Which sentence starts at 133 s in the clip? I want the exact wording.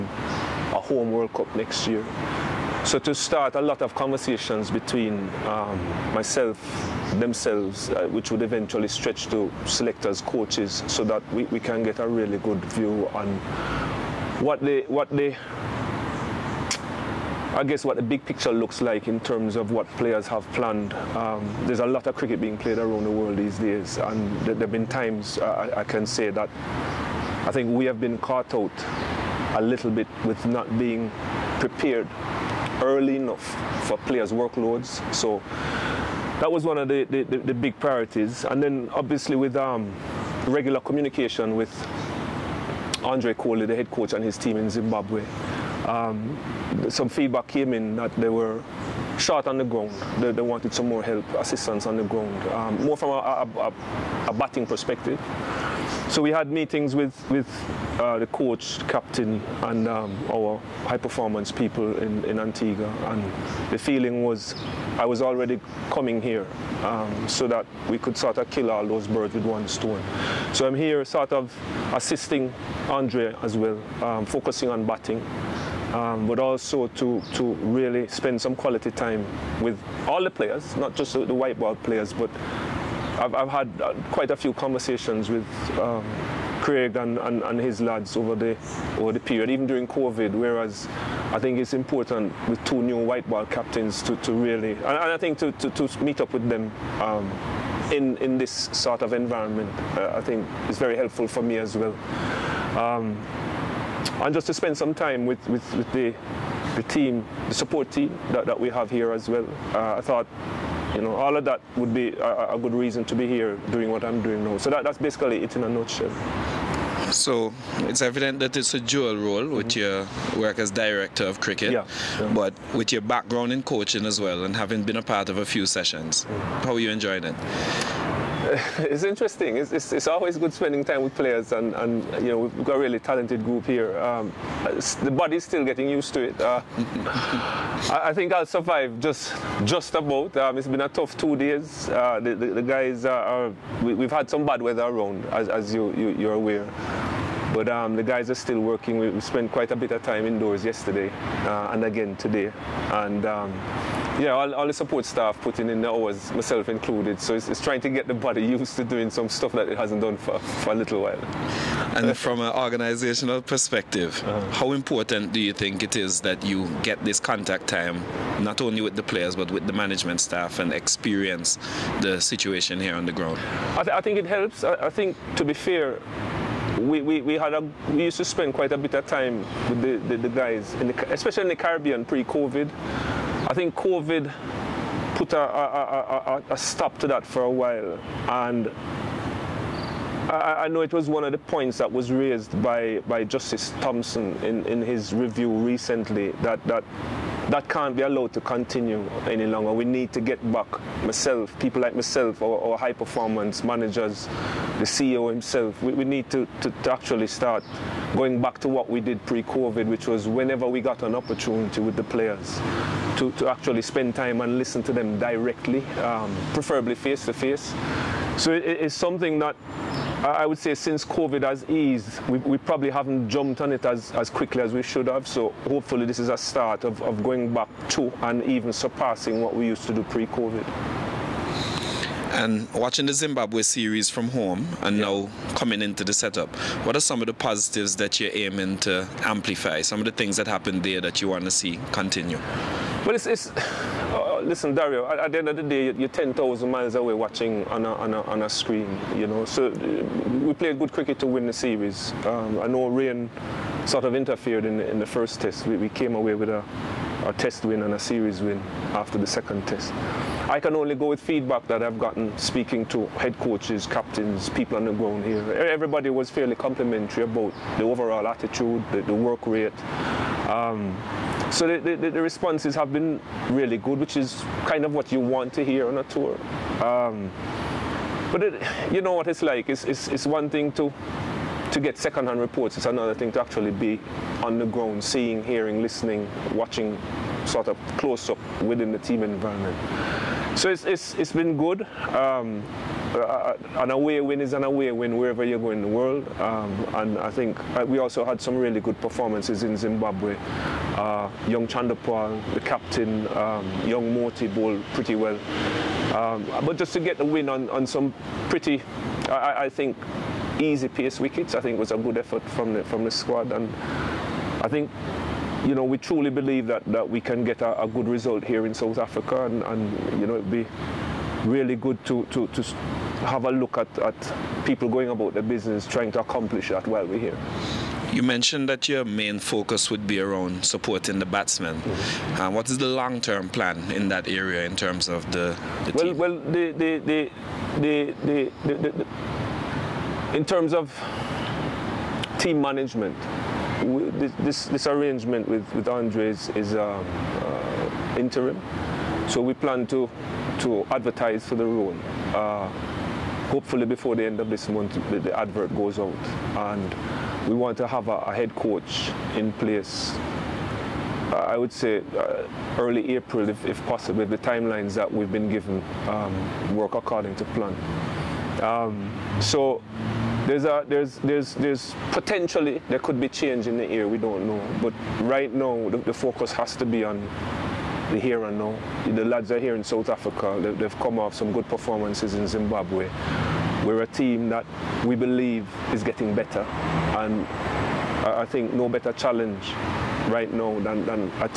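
Um, the body's still getting used to it.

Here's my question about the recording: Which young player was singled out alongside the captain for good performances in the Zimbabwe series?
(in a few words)
Chanderpaul.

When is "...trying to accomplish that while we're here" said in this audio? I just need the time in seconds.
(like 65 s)
325 s.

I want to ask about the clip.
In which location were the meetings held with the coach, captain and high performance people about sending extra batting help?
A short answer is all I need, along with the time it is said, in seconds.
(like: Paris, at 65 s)
Antigua, at 62 s.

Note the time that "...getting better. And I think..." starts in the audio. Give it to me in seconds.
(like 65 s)
386 s.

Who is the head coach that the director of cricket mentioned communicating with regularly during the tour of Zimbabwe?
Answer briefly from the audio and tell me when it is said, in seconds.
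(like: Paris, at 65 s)
Andre Coley, at 43 s.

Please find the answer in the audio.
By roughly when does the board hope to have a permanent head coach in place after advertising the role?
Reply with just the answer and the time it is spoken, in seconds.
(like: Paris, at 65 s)
early April, at 362 s.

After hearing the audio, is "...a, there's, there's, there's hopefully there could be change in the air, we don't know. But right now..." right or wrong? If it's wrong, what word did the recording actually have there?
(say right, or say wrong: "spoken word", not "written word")
wrong: "potentially", not "hopefully".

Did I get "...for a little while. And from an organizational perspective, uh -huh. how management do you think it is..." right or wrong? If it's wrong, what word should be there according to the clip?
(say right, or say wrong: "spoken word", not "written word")
wrong: "important", not "management".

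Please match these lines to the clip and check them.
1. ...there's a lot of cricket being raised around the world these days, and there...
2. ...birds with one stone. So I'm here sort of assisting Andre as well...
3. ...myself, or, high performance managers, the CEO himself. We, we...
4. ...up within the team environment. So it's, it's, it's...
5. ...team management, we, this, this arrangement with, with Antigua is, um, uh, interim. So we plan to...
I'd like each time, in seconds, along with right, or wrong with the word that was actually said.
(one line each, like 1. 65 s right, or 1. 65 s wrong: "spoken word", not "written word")
1. 21 s wrong: "played", not "raised"
2. 69 s right
3. 201 s right
4. 288 s right
5. 342 s wrong: "Andre", not "Antigua".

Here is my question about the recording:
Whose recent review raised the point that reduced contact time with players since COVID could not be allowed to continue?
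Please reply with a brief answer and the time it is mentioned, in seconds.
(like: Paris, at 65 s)
Justice Thompson, at 193 s.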